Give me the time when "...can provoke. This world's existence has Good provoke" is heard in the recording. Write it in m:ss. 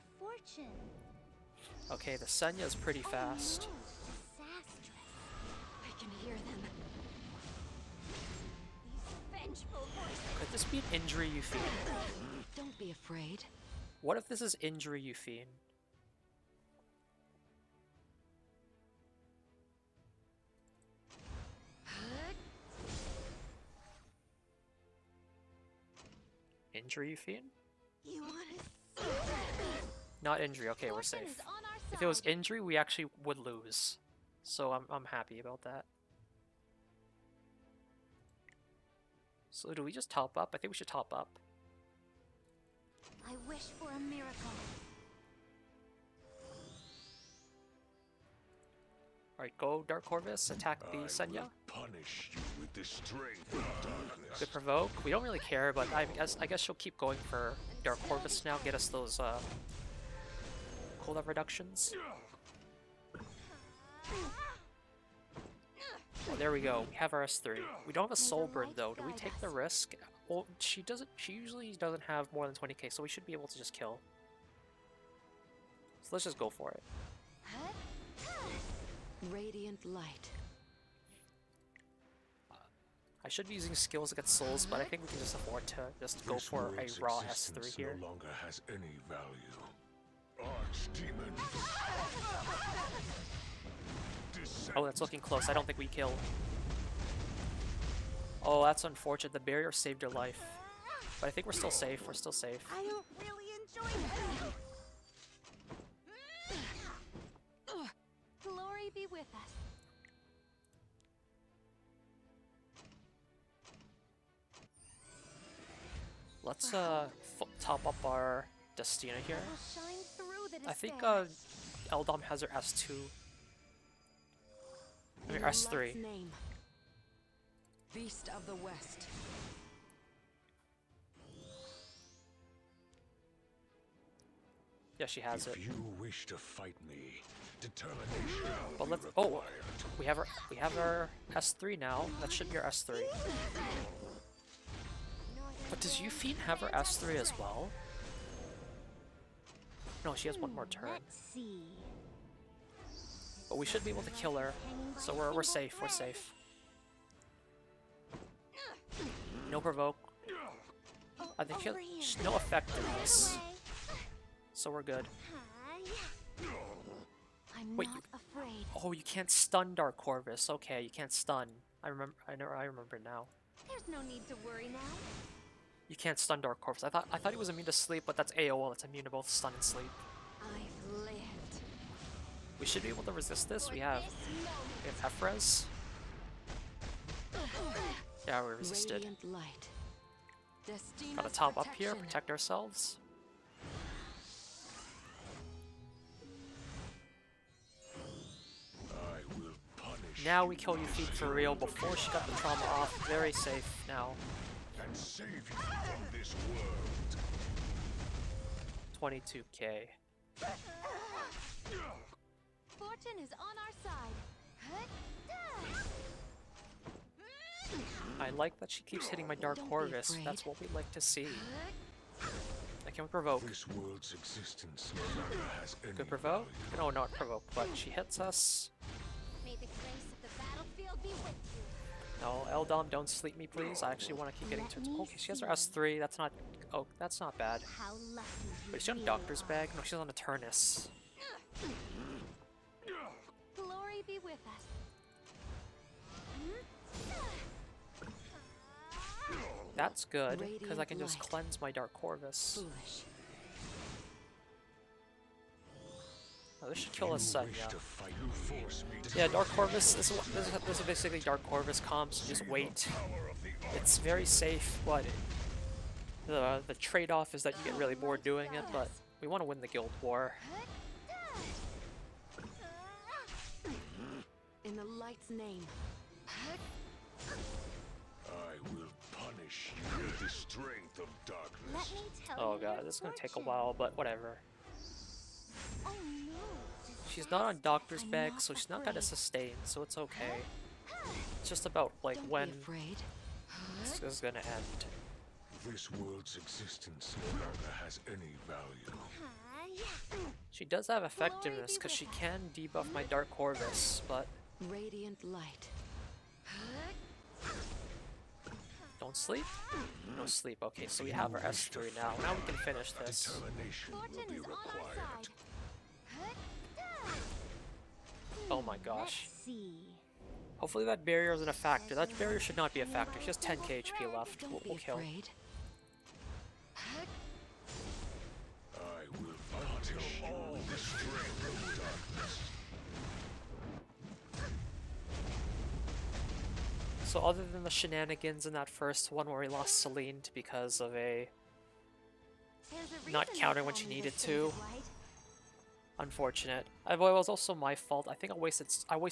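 3:42.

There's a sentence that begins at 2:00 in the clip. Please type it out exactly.
I think uh, Eldom has her S2.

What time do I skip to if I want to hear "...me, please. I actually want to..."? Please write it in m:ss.
3:53.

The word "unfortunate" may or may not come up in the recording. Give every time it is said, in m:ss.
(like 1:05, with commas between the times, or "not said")
1:38, 5:45.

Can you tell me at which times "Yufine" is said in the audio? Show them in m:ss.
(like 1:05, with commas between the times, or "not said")
2:25, 3:20.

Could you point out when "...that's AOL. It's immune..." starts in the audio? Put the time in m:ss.
2:58.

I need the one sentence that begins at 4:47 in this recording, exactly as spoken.
She's not on doctor's bag, so she's not gonna sustain, so it's okay.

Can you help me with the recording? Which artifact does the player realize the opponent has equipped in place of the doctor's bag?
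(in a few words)
Turnus.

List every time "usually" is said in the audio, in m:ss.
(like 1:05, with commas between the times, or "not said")
1:11.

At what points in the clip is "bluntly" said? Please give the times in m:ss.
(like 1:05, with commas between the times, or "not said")
not said.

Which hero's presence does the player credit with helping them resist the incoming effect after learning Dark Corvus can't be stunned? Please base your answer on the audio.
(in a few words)
Ephrez.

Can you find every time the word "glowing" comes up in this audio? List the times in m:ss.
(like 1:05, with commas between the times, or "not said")
not said.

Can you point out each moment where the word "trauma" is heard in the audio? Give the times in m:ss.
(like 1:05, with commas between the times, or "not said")
3:22.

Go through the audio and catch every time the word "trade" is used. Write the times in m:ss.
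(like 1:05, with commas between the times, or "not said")
4:26.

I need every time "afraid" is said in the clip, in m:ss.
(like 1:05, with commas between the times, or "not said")
0:12, 2:48.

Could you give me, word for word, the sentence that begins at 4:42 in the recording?
Oh god, this is going to take a while, but whatever.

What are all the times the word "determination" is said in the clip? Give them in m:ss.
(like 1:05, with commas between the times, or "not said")
2:17, 5:13.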